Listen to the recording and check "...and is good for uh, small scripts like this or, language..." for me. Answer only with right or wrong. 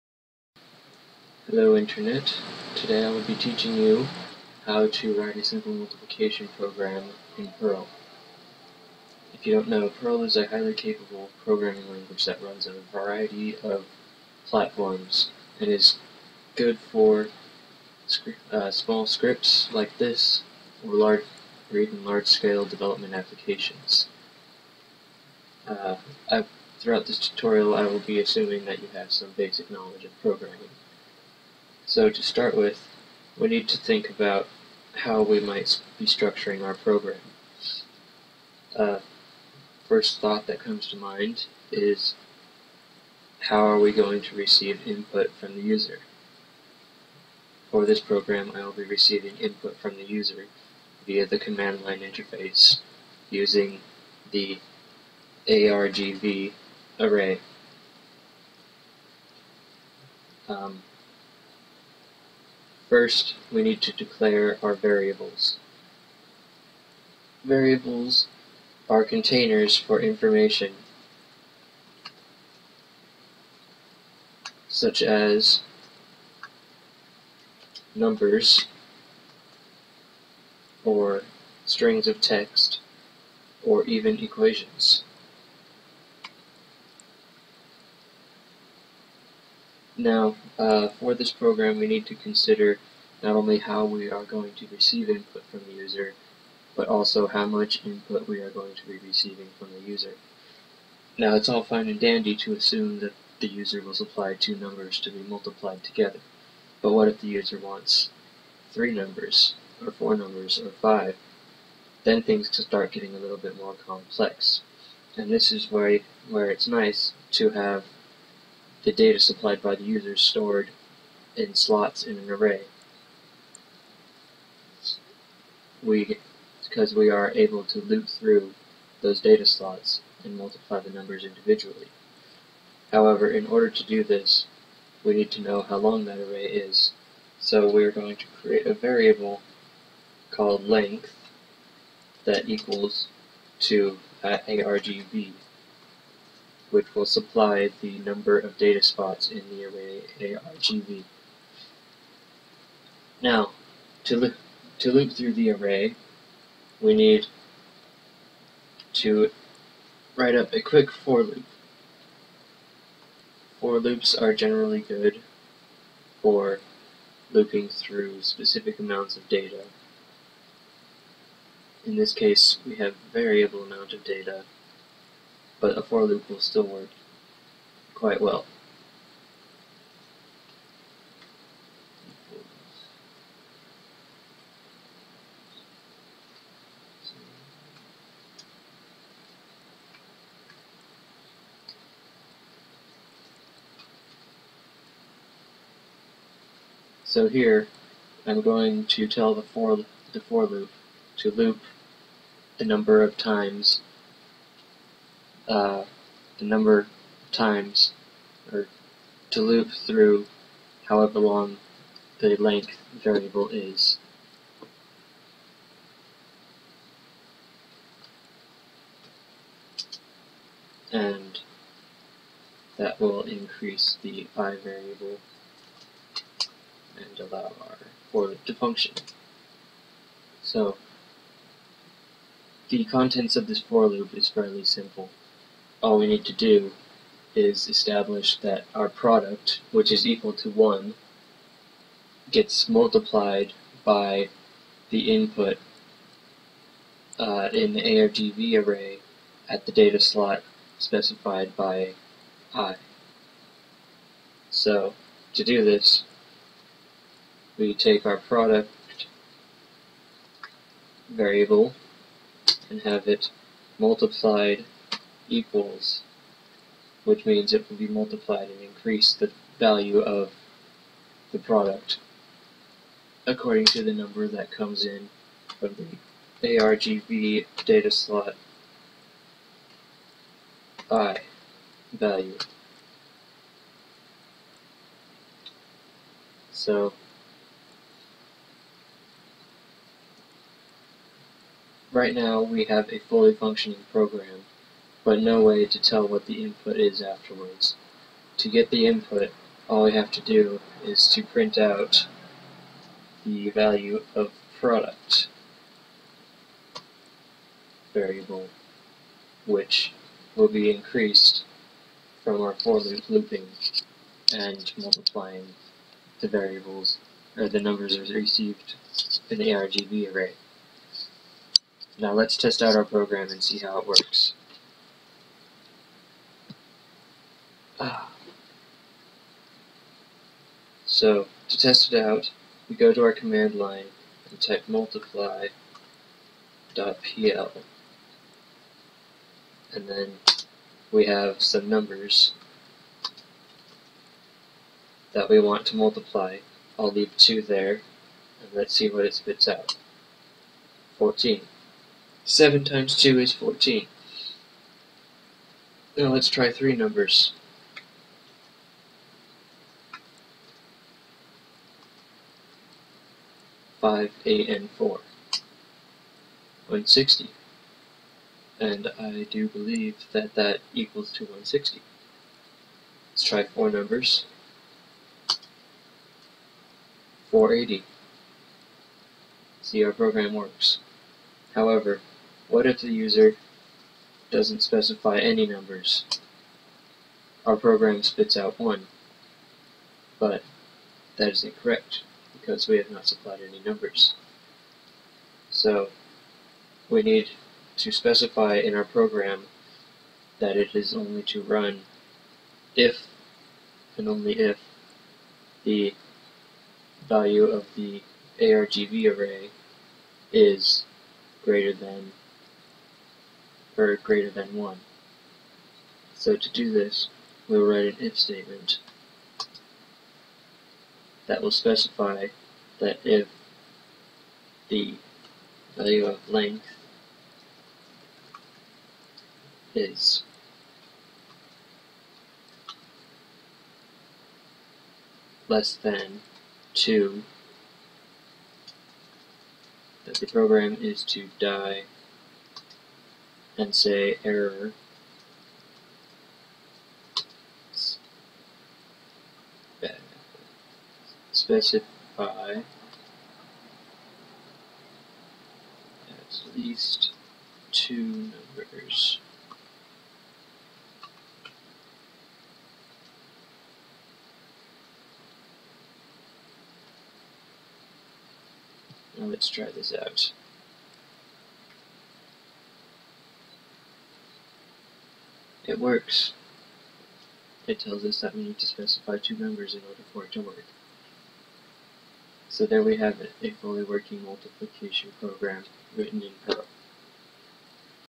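wrong.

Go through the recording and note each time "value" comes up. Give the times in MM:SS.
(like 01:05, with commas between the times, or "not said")
04:29, 04:41, 05:03, 06:47, 07:05.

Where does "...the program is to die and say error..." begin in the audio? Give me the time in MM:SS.
07:20.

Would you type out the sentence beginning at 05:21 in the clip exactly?
Now let's test out our program and see how it works.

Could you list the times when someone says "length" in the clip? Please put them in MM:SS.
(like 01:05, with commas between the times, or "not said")
02:20, 03:32, 07:06.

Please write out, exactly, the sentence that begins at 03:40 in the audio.
And that will increase the i variable and allow our for loop to function.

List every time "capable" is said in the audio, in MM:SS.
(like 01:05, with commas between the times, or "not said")
00:10.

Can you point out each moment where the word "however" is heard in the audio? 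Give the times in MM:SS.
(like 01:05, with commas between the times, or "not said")
02:12, 03:30, 06:21.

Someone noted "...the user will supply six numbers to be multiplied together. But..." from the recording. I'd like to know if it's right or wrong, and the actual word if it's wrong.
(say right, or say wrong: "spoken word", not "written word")
wrong: "two", not "six".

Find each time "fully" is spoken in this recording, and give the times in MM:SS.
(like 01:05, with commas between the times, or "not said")
04:52, 08:03.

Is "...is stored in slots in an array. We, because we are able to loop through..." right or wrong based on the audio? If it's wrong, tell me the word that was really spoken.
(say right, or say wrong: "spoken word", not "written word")
right.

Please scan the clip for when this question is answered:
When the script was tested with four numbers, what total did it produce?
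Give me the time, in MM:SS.
06:17.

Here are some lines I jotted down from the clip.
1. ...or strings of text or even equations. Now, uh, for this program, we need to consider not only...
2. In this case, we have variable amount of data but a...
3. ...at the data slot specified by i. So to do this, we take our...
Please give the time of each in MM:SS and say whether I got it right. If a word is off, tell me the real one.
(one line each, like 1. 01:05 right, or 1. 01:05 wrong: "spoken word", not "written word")
1. 01:20 right
2. 02:51 right
3. 04:09 right.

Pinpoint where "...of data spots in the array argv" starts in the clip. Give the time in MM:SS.
02:28.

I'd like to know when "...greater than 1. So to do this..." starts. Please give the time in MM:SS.
06:53.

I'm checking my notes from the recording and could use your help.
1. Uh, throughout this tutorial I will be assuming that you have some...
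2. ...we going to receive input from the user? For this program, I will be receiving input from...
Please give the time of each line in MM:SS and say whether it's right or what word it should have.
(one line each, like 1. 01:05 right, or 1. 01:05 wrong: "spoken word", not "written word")
1. 00:25 right
2. 00:43 right.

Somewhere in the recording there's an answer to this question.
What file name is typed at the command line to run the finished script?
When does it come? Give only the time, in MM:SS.
05:34.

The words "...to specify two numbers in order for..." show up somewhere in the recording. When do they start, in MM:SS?
07:58.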